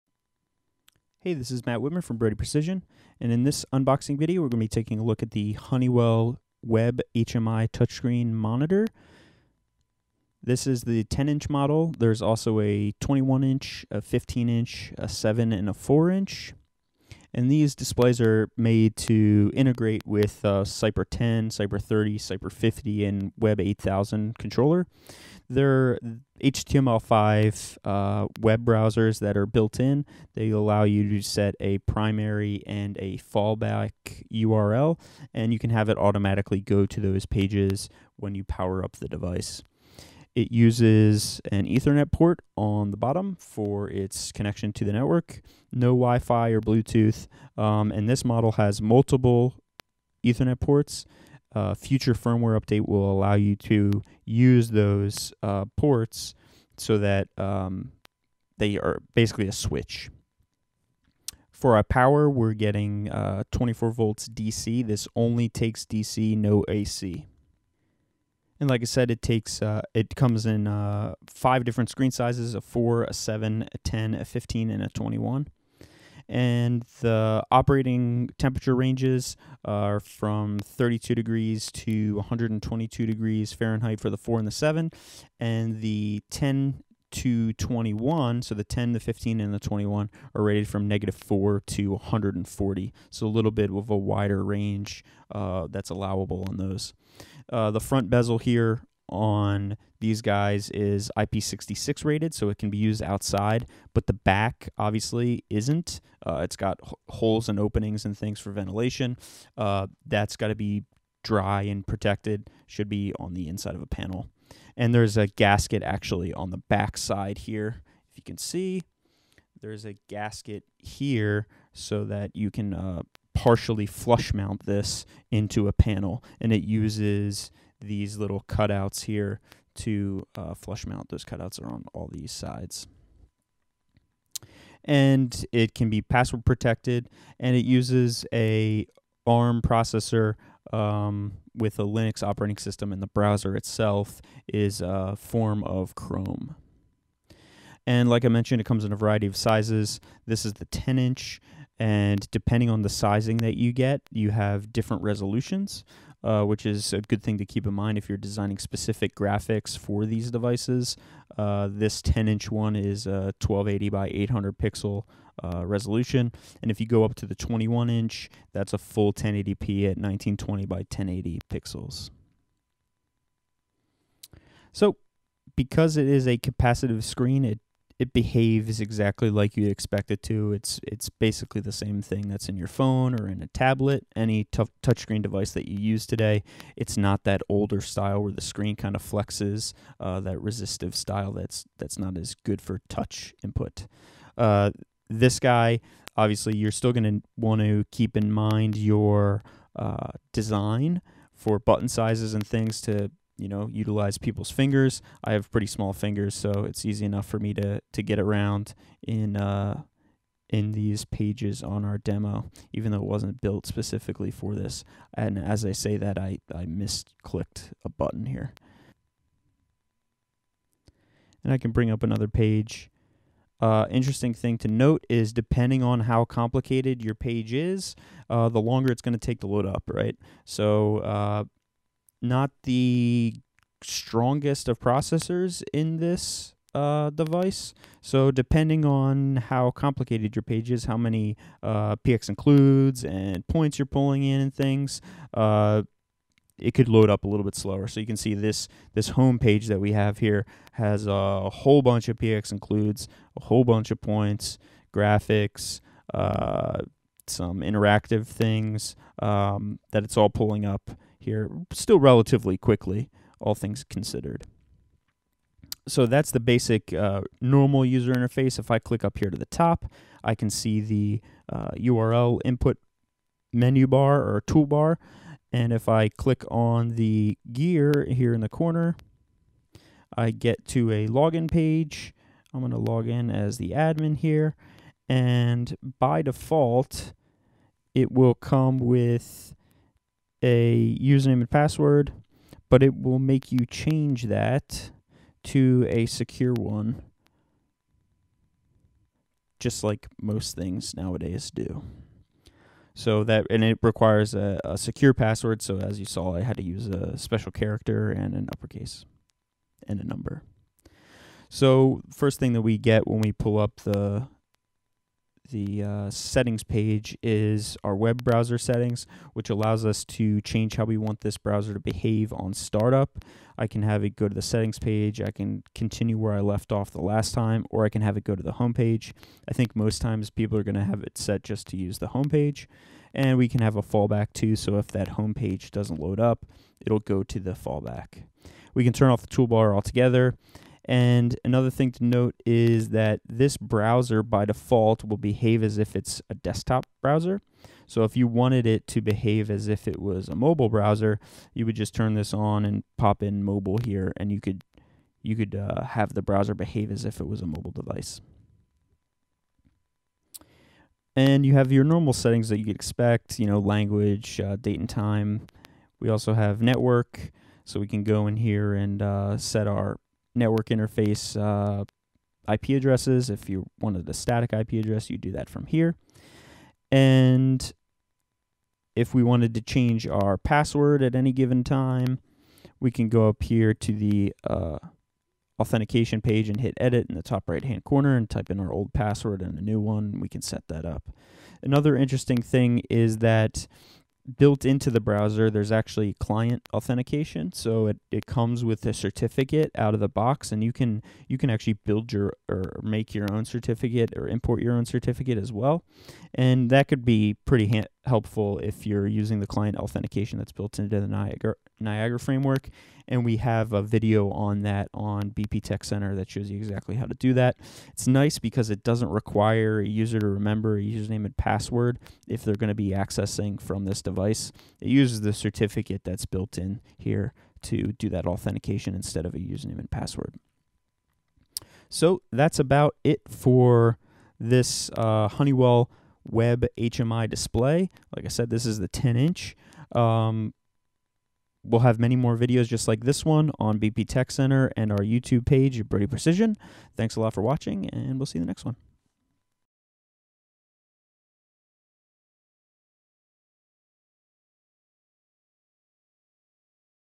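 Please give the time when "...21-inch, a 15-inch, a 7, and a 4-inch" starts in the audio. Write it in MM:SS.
00:12.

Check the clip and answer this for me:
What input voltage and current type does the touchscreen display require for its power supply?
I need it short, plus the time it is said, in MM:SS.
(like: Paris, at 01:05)
24 volts DC, at 01:03.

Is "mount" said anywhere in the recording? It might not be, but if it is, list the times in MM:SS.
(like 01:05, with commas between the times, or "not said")
02:04, 02:10.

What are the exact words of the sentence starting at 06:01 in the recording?
And you have your normal settings that you'd expect, you know, language, uh, date and time.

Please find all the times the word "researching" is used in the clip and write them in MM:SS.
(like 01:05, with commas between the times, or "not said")
not said.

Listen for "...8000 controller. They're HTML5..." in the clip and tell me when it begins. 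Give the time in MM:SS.
00:23.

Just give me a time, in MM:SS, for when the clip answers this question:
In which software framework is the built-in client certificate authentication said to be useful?
06:51.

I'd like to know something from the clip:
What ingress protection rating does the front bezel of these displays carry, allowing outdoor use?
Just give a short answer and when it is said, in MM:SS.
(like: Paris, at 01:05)
IP66, at 01:41.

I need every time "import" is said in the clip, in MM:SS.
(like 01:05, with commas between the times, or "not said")
06:44.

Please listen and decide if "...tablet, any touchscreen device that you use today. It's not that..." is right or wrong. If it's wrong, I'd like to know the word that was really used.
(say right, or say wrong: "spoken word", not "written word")
right.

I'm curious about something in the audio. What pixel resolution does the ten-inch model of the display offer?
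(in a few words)
1280 by 800.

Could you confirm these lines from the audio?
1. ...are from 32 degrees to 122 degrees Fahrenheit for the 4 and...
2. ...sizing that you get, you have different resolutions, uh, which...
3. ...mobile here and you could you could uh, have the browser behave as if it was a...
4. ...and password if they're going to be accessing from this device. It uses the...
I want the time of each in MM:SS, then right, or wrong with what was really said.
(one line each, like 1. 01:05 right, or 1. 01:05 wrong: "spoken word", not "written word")
1. 01:19 right
2. 02:32 right
3. 05:53 right
4. 07:01 right.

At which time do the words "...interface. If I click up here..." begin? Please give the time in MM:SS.
04:28.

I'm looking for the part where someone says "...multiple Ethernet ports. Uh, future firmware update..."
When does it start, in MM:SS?
00:48.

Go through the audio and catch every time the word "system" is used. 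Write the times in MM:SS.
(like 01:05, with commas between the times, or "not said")
02:22.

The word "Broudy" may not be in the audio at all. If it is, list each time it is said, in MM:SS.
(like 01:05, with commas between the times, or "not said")
00:02, 07:25.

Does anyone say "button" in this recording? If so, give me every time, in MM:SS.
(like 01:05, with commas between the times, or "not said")
03:21, 03:37.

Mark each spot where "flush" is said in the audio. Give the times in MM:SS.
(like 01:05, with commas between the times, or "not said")
02:03, 02:10.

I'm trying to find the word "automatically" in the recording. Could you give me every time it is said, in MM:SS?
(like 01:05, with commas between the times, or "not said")
00:35.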